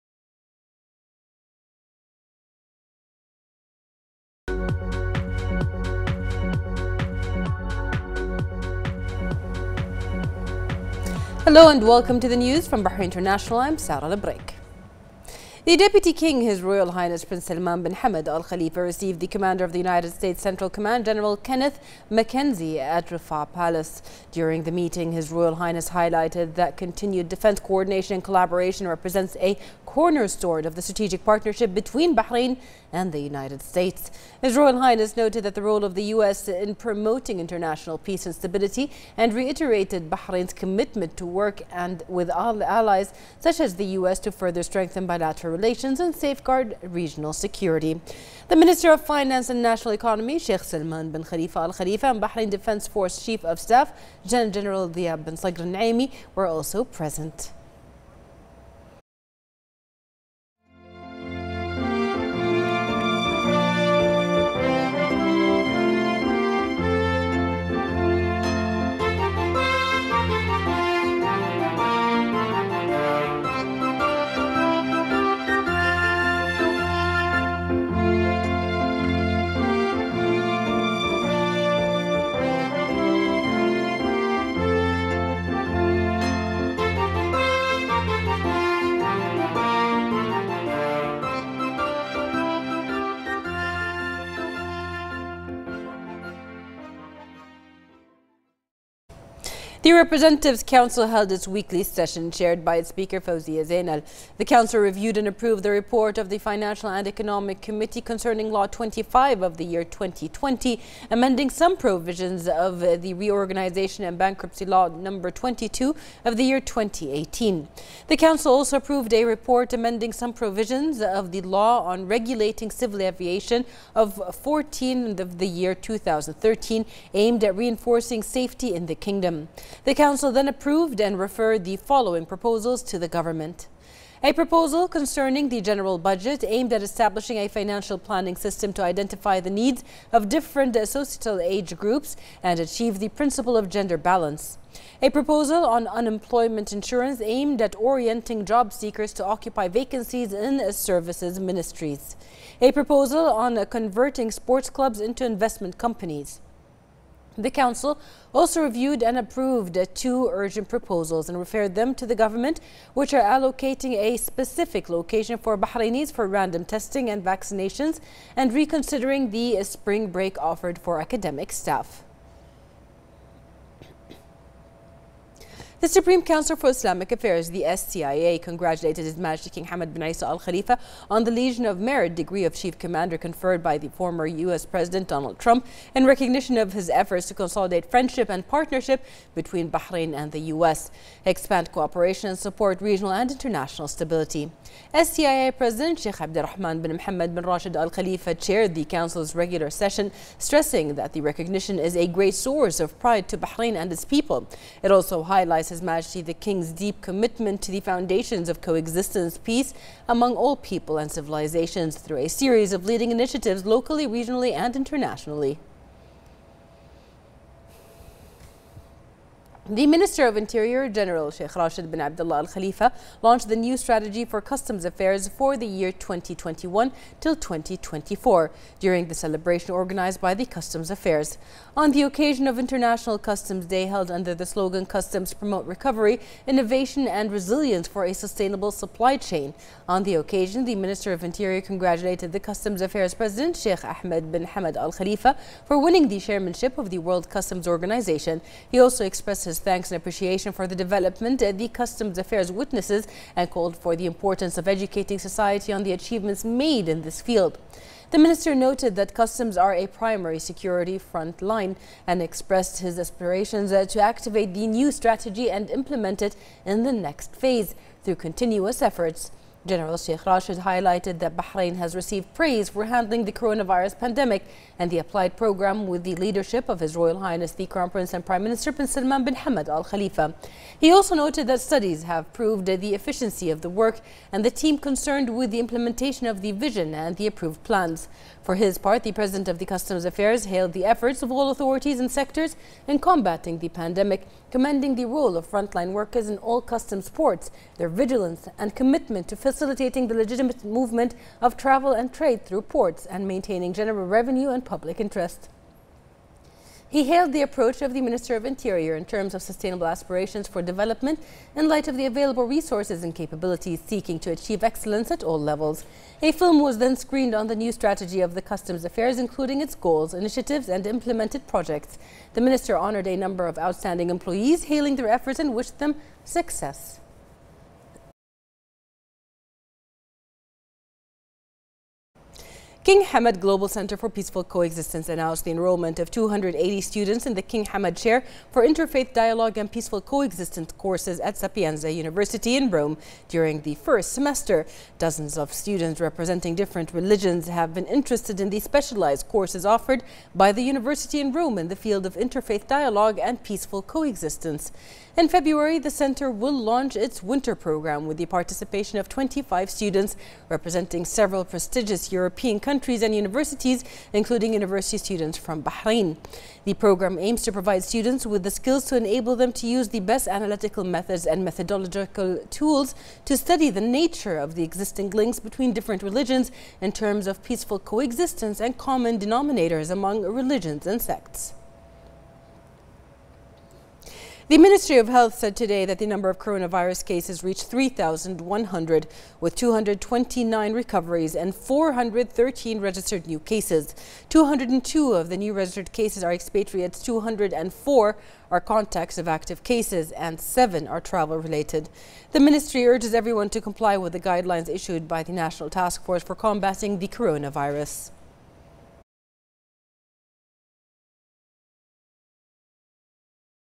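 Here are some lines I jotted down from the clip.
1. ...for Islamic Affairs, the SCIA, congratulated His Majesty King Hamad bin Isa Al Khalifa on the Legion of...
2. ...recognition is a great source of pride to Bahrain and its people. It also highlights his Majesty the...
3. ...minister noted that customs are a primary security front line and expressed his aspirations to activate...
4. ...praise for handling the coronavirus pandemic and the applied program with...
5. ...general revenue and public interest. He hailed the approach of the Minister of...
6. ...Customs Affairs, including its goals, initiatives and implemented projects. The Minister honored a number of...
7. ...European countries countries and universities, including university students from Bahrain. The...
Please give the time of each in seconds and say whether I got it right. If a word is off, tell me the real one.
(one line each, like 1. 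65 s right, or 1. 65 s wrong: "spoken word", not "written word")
1. 176 s right
2. 201 s right
3. 258 s right
4. 272 s right
5. 303 s right
6. 318 s right
7. 362 s right.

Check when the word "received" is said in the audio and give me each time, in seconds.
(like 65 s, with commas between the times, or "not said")
18 s, 271 s.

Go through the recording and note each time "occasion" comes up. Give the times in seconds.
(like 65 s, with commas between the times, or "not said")
232 s, 240 s.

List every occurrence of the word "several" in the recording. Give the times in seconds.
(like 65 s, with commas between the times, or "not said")
361 s.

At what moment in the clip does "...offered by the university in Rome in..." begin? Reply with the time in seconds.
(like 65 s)
349 s.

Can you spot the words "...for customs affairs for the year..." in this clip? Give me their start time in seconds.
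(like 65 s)
224 s.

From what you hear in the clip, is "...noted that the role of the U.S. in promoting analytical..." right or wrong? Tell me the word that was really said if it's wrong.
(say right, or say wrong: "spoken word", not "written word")
wrong: "international", not "analytical".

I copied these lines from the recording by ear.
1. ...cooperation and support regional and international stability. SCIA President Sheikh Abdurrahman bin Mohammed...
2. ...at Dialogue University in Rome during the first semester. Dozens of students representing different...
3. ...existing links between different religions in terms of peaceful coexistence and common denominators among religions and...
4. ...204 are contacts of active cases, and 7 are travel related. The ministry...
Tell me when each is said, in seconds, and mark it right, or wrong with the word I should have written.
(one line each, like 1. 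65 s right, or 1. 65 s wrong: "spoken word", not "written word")
1. 191 s right
2. 341 s wrong: "Sapienza", not "Dialogue"
3. 374 s right
4. 397 s right.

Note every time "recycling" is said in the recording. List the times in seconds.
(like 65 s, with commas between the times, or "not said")
not said.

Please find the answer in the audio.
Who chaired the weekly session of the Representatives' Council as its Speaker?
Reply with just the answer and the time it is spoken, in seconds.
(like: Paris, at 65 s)
Fawzia Zainal, at 103 s.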